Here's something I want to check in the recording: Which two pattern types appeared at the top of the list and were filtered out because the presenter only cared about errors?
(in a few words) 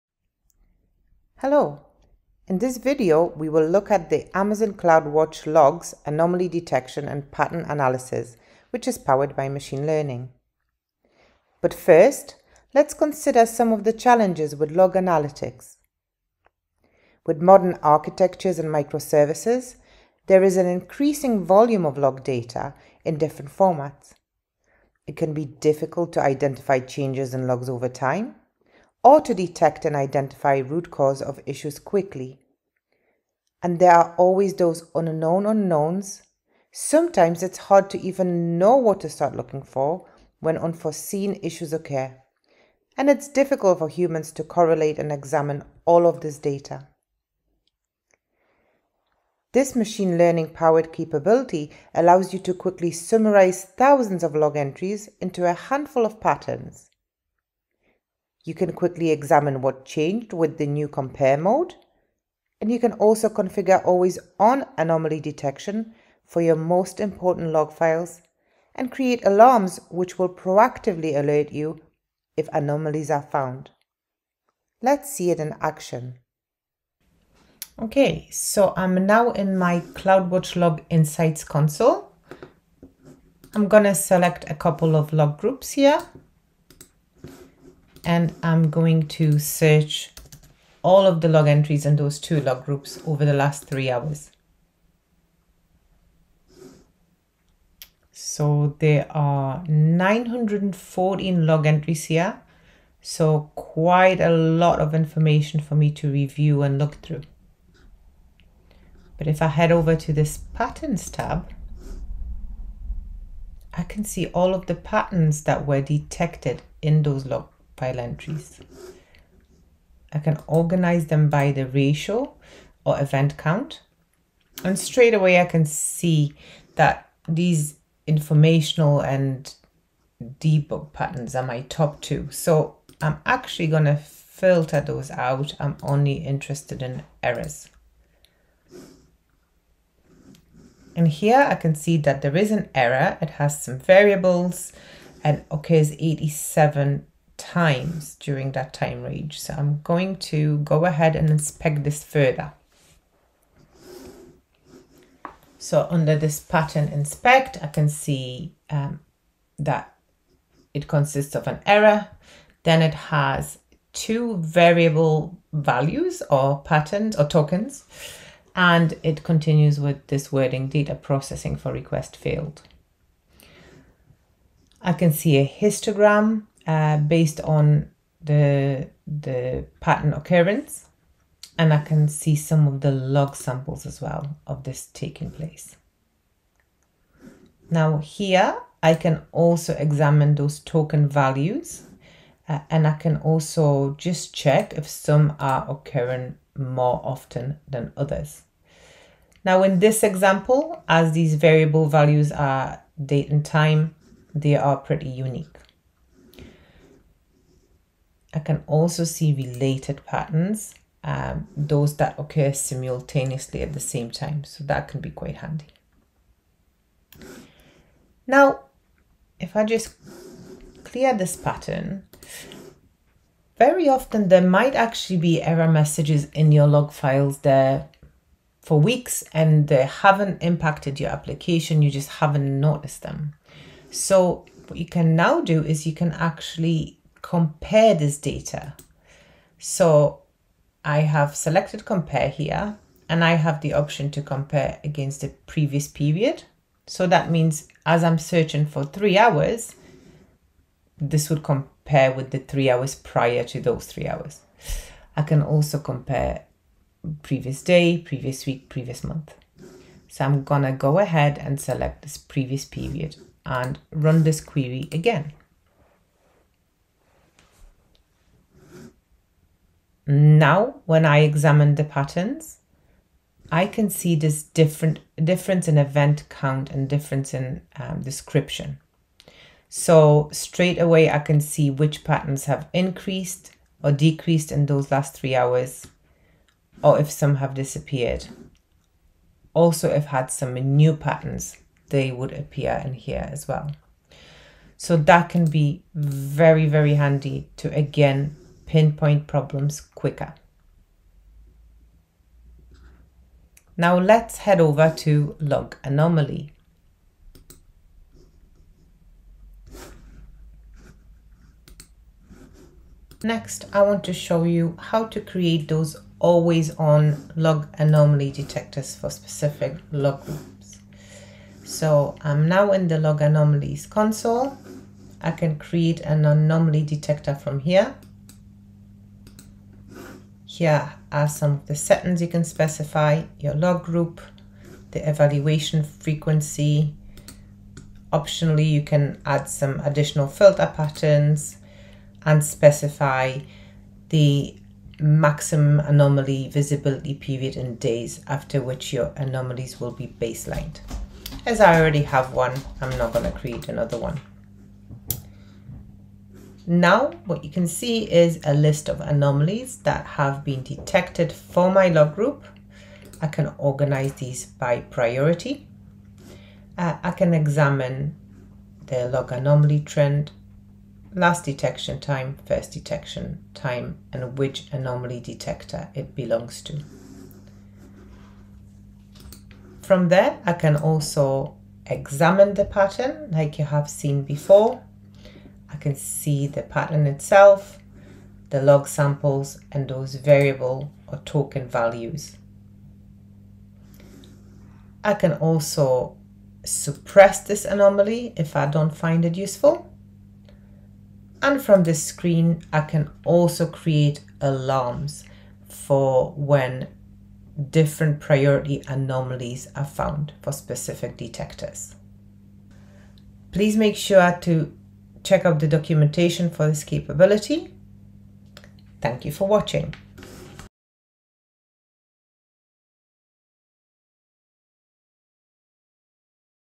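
Informational and debug.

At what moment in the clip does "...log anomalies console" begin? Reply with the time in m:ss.
5:22.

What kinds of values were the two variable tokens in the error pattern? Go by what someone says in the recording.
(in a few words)
Date and time.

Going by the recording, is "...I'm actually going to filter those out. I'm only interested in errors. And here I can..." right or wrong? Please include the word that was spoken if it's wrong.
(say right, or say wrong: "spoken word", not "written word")
right.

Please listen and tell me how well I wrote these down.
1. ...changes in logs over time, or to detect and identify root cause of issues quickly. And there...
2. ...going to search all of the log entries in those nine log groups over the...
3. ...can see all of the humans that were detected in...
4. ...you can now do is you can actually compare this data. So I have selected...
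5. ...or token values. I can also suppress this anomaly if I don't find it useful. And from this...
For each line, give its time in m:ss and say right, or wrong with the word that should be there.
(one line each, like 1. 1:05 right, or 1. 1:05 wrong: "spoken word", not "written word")
1. 0:26 right
2. 1:28 wrong: "two", not "nine"
3. 1:53 wrong: "patterns", not "humans"
4. 3:54 right
5. 6:31 right.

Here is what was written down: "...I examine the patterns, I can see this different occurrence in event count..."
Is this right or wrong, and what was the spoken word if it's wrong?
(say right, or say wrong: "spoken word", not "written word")
wrong: "difference", not "occurrence".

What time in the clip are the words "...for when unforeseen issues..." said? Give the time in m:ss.
0:39.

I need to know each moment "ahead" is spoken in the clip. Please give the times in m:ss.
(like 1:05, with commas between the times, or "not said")
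2:30, 4:20.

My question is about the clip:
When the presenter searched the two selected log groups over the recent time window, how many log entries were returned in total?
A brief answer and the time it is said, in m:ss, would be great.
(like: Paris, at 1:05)
914, at 1:39.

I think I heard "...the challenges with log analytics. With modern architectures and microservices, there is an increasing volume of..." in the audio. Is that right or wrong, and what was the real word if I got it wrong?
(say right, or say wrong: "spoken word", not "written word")
right.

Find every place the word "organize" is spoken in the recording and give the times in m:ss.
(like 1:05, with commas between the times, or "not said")
2:00, 6:03.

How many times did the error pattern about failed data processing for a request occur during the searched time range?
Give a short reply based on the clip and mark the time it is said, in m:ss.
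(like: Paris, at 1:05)
87, at 2:25.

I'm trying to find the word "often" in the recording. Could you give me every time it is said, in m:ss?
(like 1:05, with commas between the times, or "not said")
3:17, 3:43.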